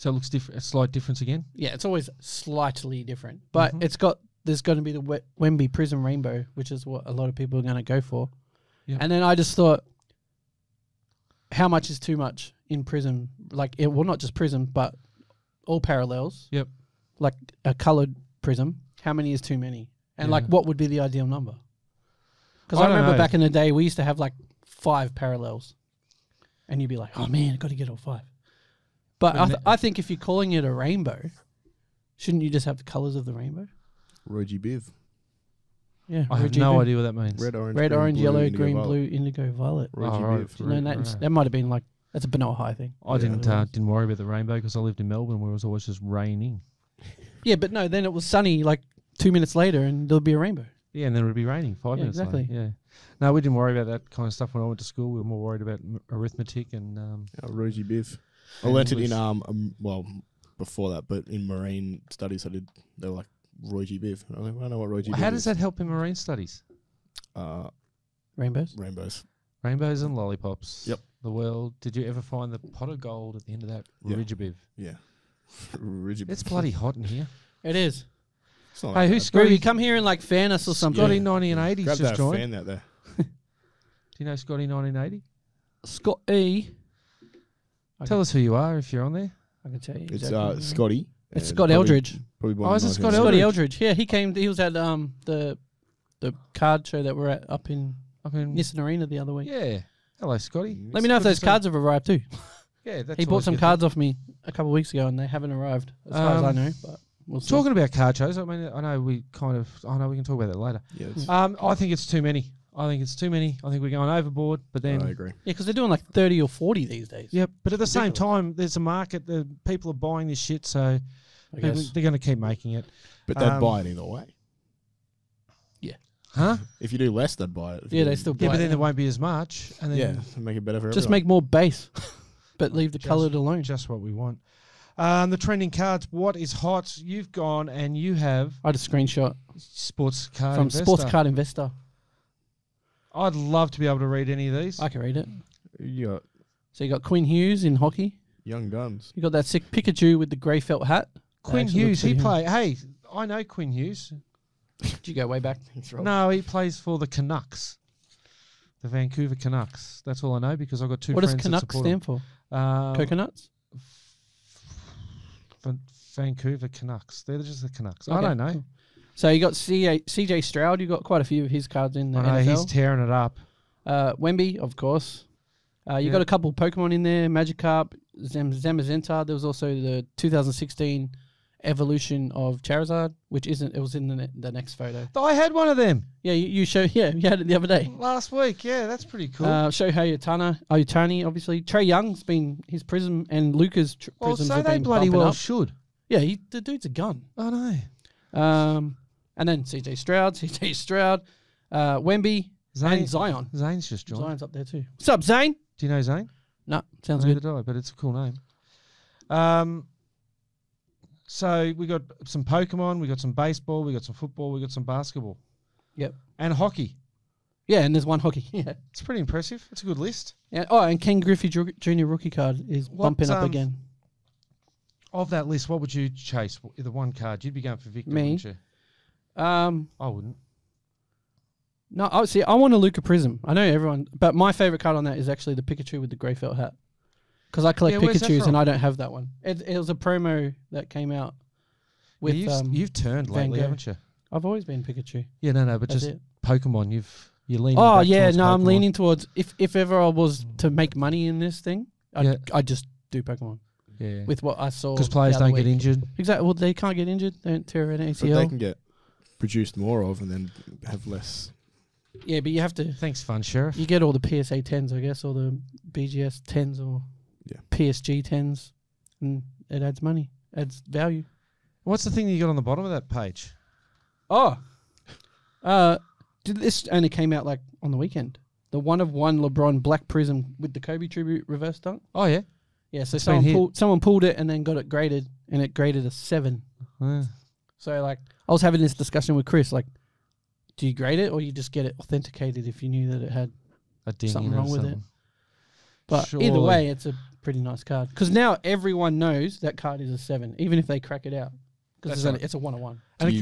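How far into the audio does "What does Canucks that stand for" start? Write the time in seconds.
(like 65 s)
161 s.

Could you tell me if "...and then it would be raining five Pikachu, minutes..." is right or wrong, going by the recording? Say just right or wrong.
wrong.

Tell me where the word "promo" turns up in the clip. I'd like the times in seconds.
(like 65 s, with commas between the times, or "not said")
239 s.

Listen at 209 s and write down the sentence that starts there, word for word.
Um, so we got some Pokemon, we got some baseball, we got some football, we got some basketball.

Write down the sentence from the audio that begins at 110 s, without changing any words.
Yeah, um, I think it's too many.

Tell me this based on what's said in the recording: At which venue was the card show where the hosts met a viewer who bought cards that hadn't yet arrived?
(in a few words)
Nissan Arena.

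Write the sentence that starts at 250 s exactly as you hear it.
make money in this thing, I'd, Yeah.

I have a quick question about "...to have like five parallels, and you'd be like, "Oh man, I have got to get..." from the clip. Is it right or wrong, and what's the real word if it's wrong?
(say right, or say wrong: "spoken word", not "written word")
right.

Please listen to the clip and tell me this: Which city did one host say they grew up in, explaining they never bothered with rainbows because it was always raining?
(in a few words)
Melbourne.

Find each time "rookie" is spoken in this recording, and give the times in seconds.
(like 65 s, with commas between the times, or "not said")
222 s.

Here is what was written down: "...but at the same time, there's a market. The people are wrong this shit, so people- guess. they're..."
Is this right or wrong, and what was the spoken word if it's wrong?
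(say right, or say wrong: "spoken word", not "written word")
wrong: "buying", not "wrong".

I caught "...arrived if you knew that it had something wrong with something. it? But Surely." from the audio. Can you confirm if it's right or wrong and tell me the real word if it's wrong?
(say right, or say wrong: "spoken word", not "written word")
wrong: "authenticated", not "arrived".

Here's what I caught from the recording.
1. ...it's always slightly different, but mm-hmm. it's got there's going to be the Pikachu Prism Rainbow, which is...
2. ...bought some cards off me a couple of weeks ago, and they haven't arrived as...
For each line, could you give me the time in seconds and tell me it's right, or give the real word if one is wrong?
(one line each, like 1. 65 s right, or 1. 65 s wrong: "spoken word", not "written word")
1. 1 s wrong: "Wemby", not "Pikachu"
2. 103 s right.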